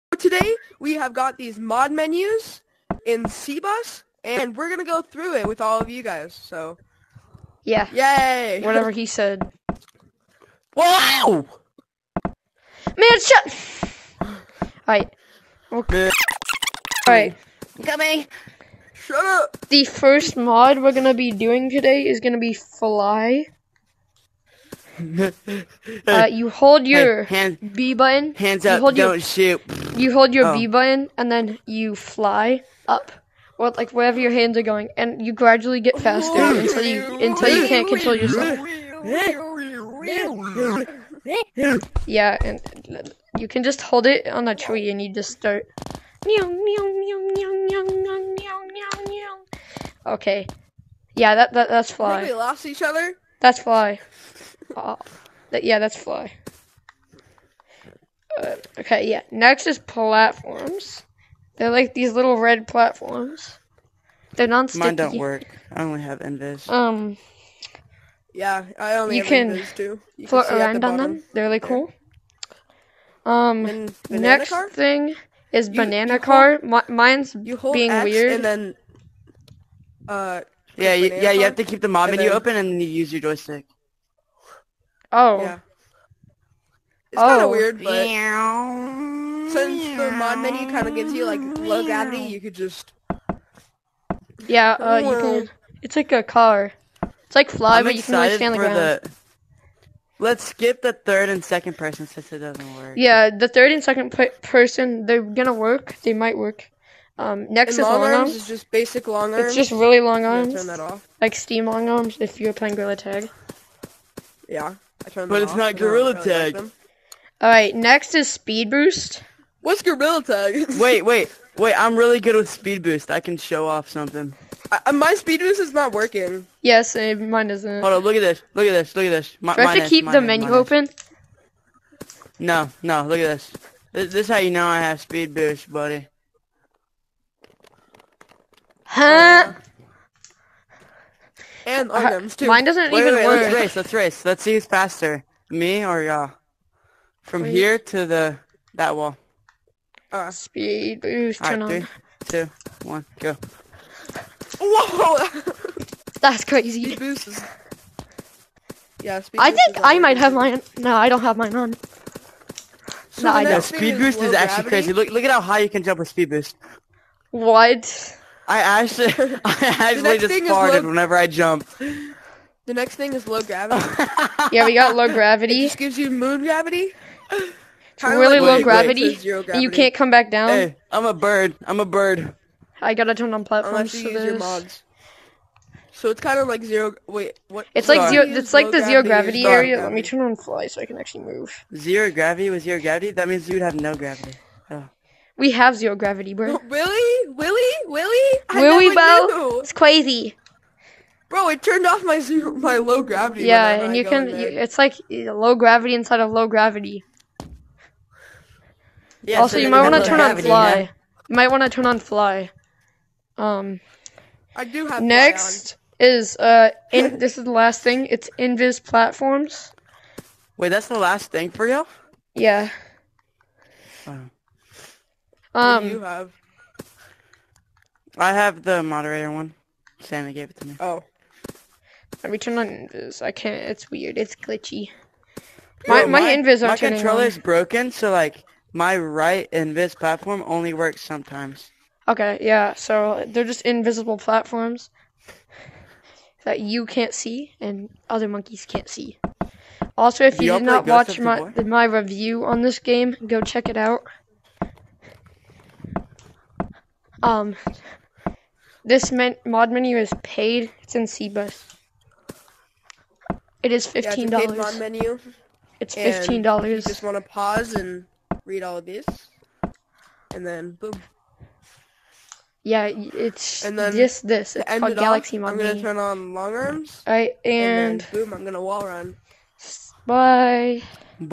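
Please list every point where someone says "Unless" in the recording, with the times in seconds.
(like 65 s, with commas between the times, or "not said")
183 s.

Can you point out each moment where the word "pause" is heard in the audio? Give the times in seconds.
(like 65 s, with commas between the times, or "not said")
267 s.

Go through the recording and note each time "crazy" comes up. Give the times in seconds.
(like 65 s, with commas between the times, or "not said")
156 s, 164 s, 199 s.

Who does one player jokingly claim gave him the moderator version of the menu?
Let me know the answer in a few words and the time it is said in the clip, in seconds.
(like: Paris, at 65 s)
Santa, at 229 s.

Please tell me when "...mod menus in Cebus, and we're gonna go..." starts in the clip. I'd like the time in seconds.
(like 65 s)
1 s.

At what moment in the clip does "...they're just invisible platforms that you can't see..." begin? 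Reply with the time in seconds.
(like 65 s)
243 s.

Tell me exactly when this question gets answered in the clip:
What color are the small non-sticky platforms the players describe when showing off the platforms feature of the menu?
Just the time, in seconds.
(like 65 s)
62 s.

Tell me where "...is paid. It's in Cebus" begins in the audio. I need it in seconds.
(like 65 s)
259 s.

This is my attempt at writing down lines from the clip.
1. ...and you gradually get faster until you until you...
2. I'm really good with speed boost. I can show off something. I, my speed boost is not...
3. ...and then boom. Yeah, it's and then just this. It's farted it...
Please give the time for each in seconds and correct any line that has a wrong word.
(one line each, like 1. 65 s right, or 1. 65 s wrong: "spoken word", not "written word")
1. 34 s right
2. 121 s right
3. 270 s wrong: "called", not "farted".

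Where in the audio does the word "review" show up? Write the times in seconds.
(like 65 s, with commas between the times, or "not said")
251 s.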